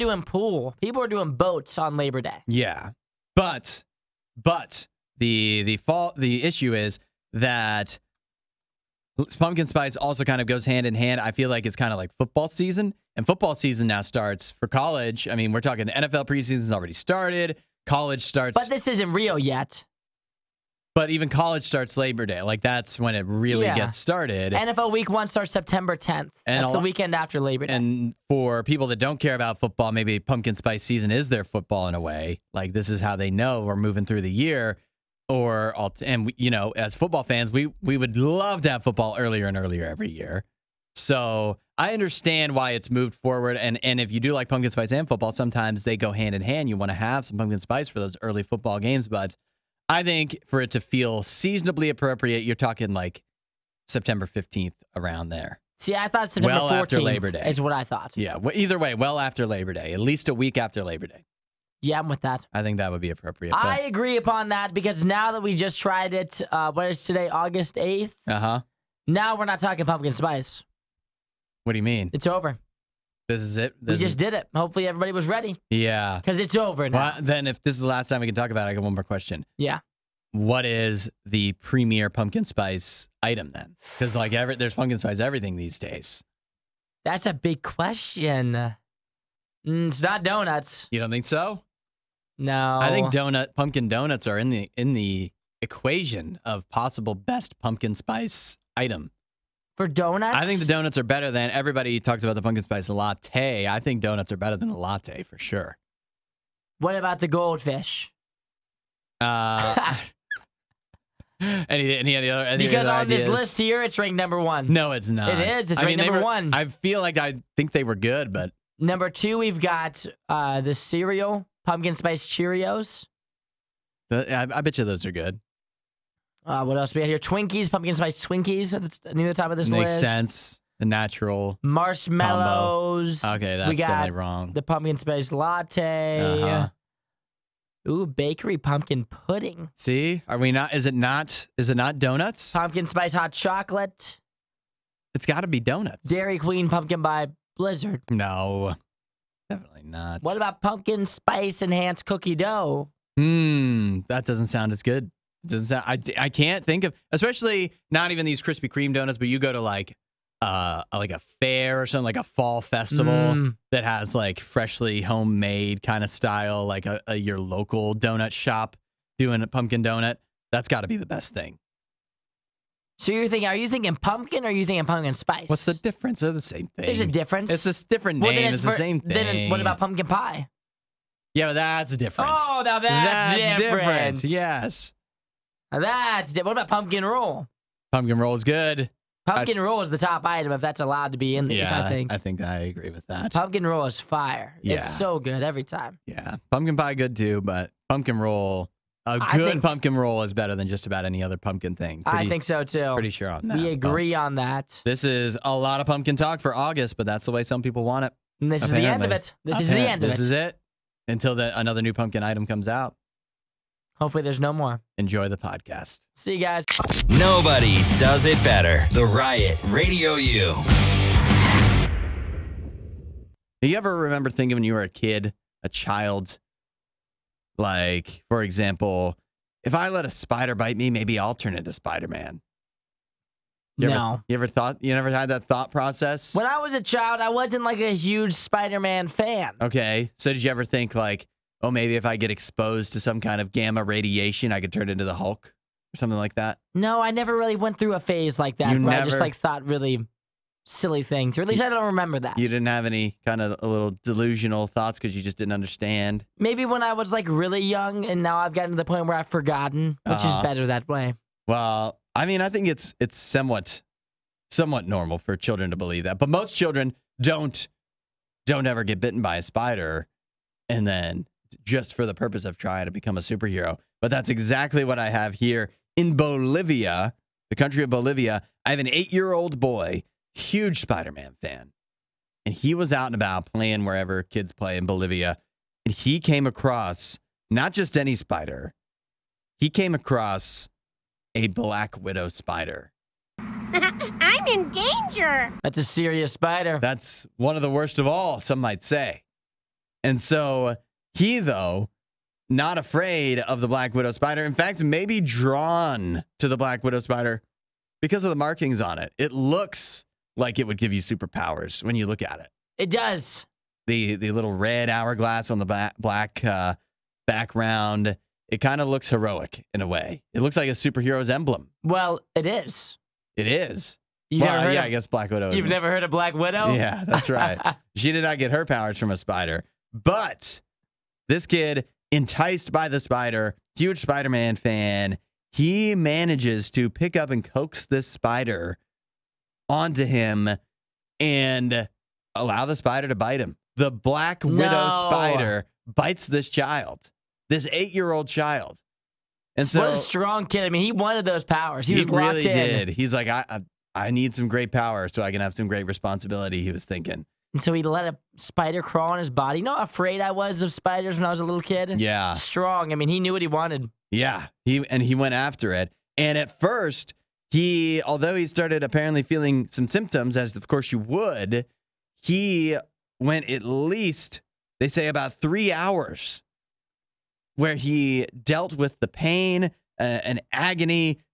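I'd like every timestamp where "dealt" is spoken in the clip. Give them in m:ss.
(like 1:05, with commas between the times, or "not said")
6:18.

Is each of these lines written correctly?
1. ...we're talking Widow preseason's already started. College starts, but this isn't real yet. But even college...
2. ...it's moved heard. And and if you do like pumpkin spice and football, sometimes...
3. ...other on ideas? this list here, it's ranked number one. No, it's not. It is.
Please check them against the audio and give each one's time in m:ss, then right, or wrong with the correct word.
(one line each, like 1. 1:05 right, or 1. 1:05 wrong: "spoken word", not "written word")
1. 0:15 wrong: "NFL", not "Widow"
2. 0:42 wrong: "forward", not "heard"
3. 1:52 right.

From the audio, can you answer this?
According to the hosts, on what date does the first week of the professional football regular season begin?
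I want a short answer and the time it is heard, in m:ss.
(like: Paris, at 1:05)
September 10th, at 0:25.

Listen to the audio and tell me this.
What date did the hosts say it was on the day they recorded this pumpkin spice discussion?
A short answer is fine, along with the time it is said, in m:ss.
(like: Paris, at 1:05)
August 8th, at 1:07.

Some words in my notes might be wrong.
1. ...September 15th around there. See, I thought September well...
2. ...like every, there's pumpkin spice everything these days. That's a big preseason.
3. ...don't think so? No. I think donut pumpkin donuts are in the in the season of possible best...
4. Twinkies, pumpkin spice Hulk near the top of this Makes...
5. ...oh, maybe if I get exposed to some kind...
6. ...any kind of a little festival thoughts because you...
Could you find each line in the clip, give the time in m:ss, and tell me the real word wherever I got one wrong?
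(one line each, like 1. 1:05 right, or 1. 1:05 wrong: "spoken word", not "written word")
1. 0:53 right
2. 1:24 wrong: "question", not "preseason"
3. 1:30 wrong: "equation", not "season"
4. 2:07 wrong: "Twinkies", not "Hulk"
5. 4:01 right
6. 4:12 wrong: "delusional", not "festival".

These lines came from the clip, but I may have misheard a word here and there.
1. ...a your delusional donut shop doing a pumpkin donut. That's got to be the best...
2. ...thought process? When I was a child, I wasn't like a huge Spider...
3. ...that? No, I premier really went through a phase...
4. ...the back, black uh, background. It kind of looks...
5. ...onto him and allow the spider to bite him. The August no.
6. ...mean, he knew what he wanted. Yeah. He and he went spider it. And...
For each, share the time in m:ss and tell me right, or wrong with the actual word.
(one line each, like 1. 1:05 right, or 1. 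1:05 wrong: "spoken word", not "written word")
1. 2:47 wrong: "local", not "delusional"
2. 3:55 right
3. 4:06 wrong: "never", not "premier"
4. 5:15 right
5. 5:39 wrong: "Black", not "August"
6. 6:02 wrong: "after", not "spider".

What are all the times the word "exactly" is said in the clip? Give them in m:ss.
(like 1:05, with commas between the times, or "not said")
4:34.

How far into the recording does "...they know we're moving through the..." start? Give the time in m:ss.
0:33.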